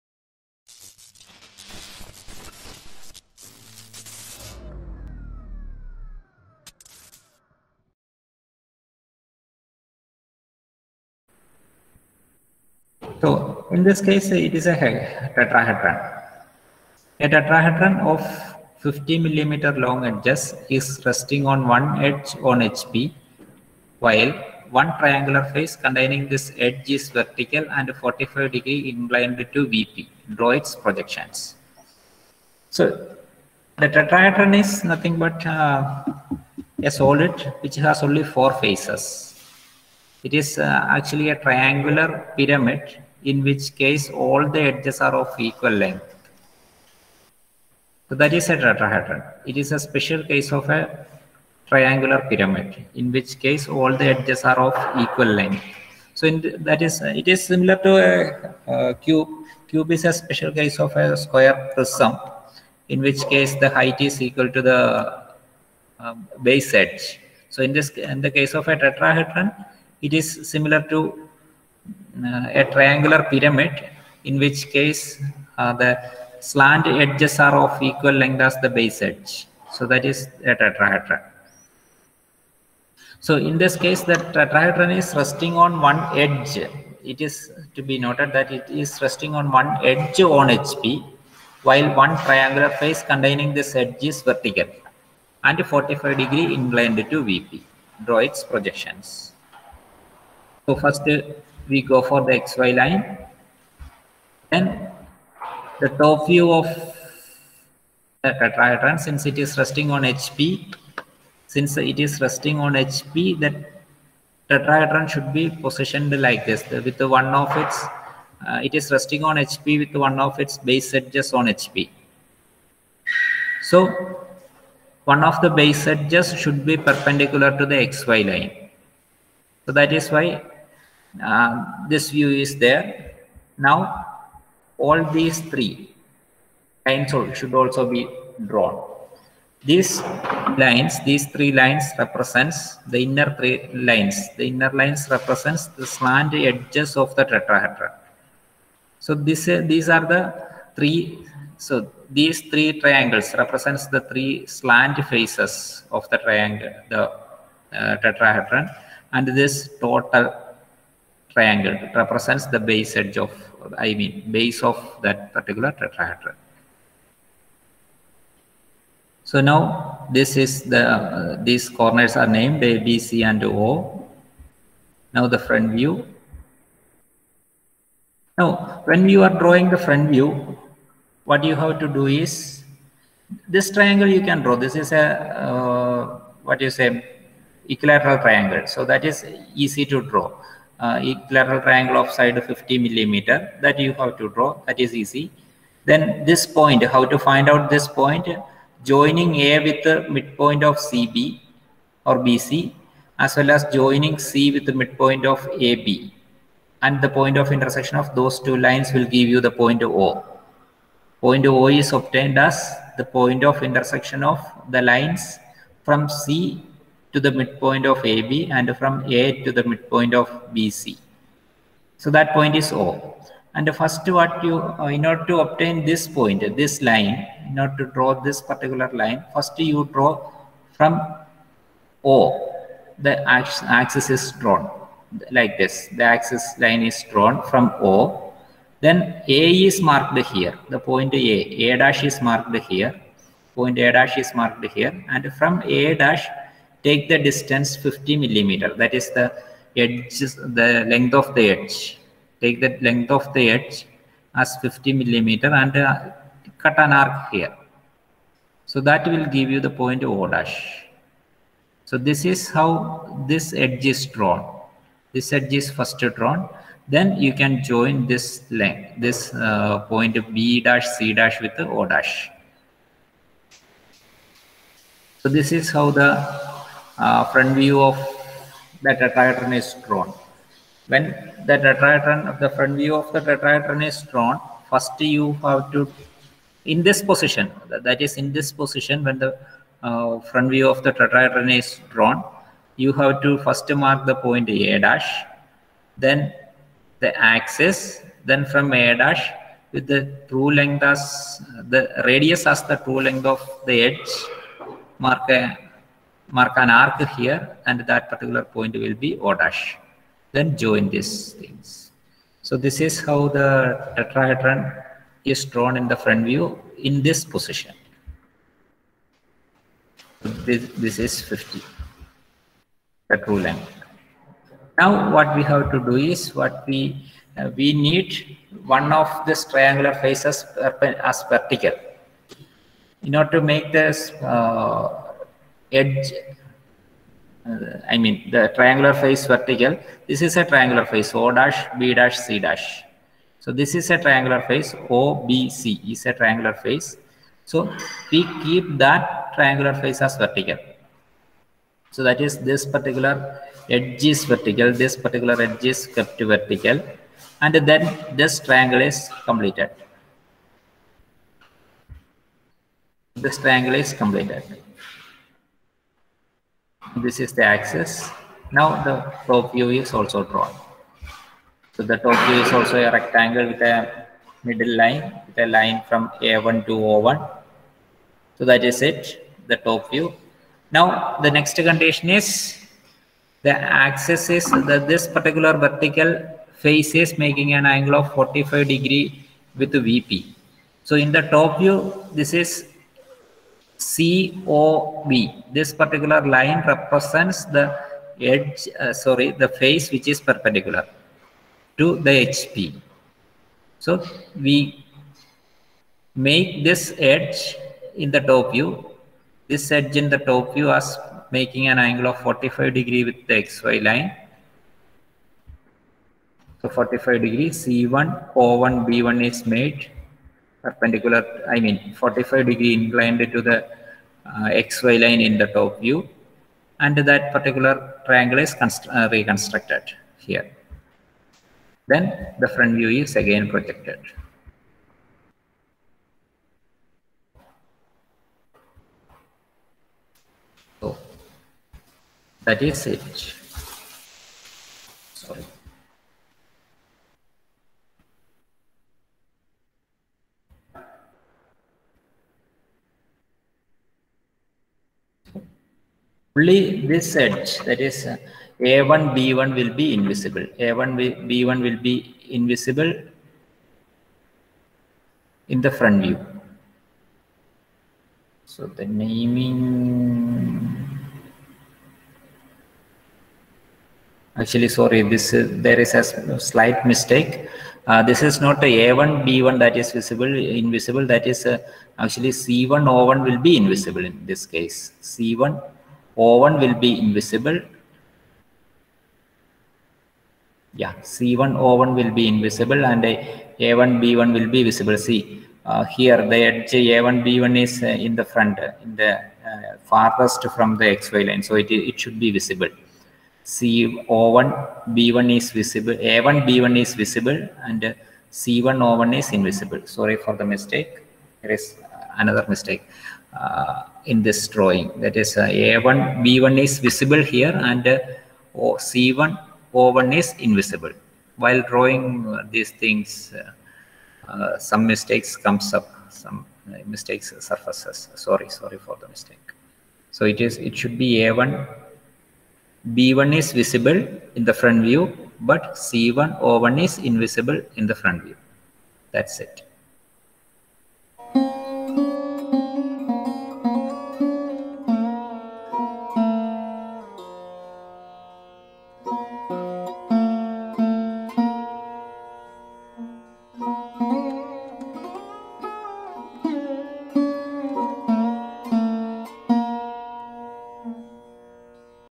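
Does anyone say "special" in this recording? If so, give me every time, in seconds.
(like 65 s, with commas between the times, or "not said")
49 s, 60 s.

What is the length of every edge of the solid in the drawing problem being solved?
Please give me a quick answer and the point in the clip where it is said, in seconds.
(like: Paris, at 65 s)
50 millimeter, at 18 s.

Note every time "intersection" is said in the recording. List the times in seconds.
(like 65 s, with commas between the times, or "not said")
207 s, 213 s.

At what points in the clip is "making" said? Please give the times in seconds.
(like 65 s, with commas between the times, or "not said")
387 s, 411 s.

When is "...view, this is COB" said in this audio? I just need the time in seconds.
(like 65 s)
391 s.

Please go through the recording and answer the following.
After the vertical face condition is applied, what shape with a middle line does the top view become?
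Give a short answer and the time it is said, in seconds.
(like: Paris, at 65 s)
Rectangle, at 372 s.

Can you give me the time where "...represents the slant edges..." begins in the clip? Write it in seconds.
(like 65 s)
145 s.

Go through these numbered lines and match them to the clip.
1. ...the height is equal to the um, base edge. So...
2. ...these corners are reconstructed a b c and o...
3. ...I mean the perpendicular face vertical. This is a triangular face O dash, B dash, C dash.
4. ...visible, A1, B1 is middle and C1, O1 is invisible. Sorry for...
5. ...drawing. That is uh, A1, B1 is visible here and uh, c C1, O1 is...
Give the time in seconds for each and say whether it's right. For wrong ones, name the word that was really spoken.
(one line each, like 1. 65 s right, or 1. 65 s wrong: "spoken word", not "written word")
1. 63 s right
2. 171 s wrong: "named", not "reconstructed"
3. 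337 s wrong: "triangular", not "perpendicular"
4. 505 s wrong: "visible", not "middle"
5. 514 s right.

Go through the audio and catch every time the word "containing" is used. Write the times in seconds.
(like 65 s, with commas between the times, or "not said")
25 s, 93 s.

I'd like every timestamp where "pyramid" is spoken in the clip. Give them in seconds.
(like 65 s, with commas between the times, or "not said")
42 s, 52 s, 73 s.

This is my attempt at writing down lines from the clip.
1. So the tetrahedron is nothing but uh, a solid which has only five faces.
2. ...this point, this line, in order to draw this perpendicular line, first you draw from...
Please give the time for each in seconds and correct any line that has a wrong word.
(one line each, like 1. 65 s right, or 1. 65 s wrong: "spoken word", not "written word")
1. 32 s wrong: "four", not "five"
2. 225 s wrong: "particular", not "perpendicular".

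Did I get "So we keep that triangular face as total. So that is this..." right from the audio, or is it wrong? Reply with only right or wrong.
wrong.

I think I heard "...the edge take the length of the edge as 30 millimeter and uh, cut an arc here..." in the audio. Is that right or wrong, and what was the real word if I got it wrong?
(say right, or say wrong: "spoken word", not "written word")
wrong: "50", not "30".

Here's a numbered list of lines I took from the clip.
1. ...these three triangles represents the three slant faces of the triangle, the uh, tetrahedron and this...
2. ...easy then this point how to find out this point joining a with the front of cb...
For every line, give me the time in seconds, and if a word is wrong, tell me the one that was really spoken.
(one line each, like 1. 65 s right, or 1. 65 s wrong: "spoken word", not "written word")
1. 152 s right
2. 194 s wrong: "midpoint", not "front".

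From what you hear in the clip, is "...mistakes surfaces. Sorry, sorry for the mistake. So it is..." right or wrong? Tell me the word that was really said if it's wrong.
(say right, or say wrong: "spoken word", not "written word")
right.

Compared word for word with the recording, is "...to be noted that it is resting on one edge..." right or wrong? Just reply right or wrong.
right.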